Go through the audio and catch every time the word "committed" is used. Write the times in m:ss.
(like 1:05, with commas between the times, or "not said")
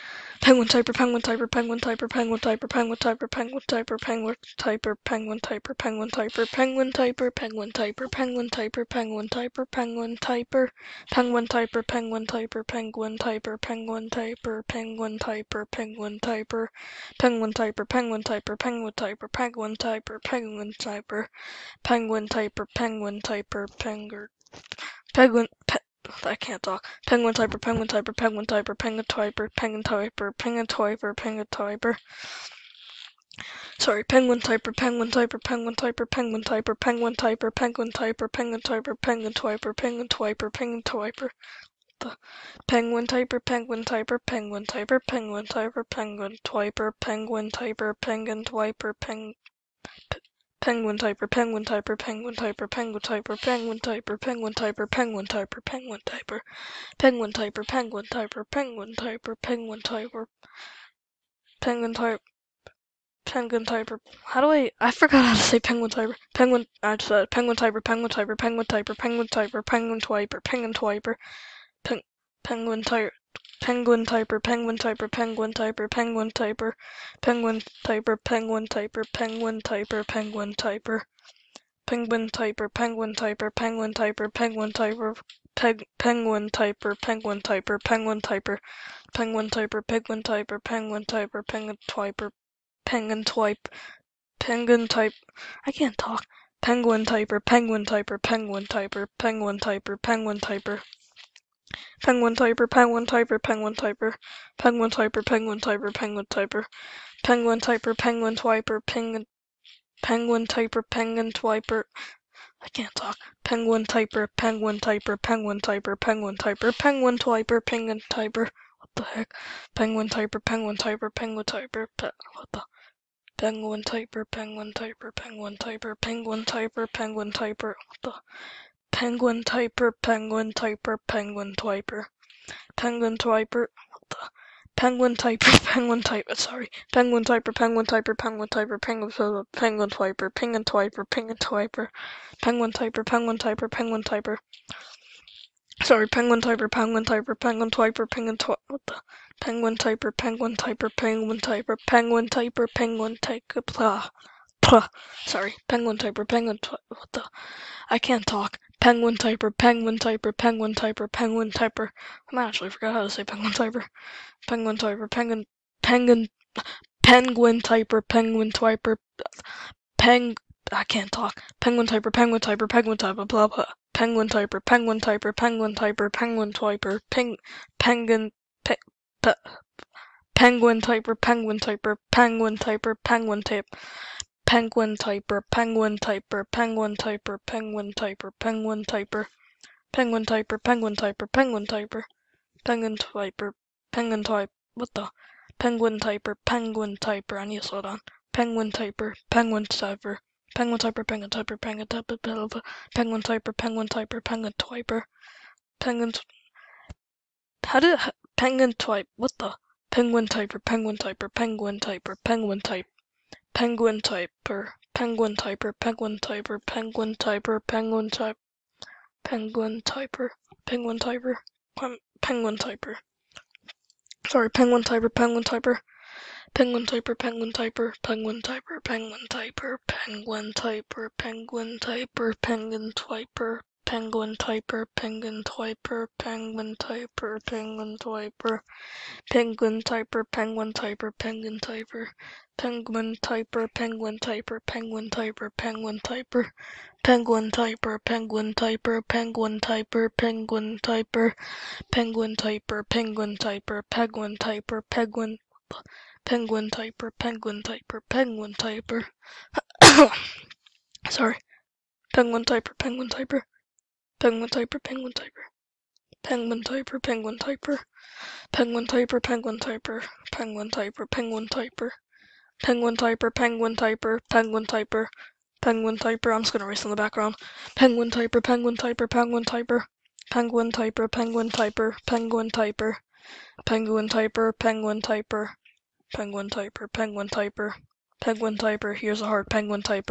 not said.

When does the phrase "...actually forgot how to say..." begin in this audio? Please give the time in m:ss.
2:42.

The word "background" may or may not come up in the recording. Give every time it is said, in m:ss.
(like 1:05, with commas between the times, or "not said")
4:36.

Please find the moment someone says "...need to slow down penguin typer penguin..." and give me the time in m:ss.
3:17.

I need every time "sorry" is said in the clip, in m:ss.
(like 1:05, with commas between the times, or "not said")
0:33, 2:16, 2:25, 2:35, 3:44, 4:21.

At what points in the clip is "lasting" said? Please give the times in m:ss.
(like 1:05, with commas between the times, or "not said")
not said.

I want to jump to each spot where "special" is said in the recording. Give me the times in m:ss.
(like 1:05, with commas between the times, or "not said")
not said.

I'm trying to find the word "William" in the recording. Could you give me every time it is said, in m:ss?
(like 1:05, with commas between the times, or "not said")
not said.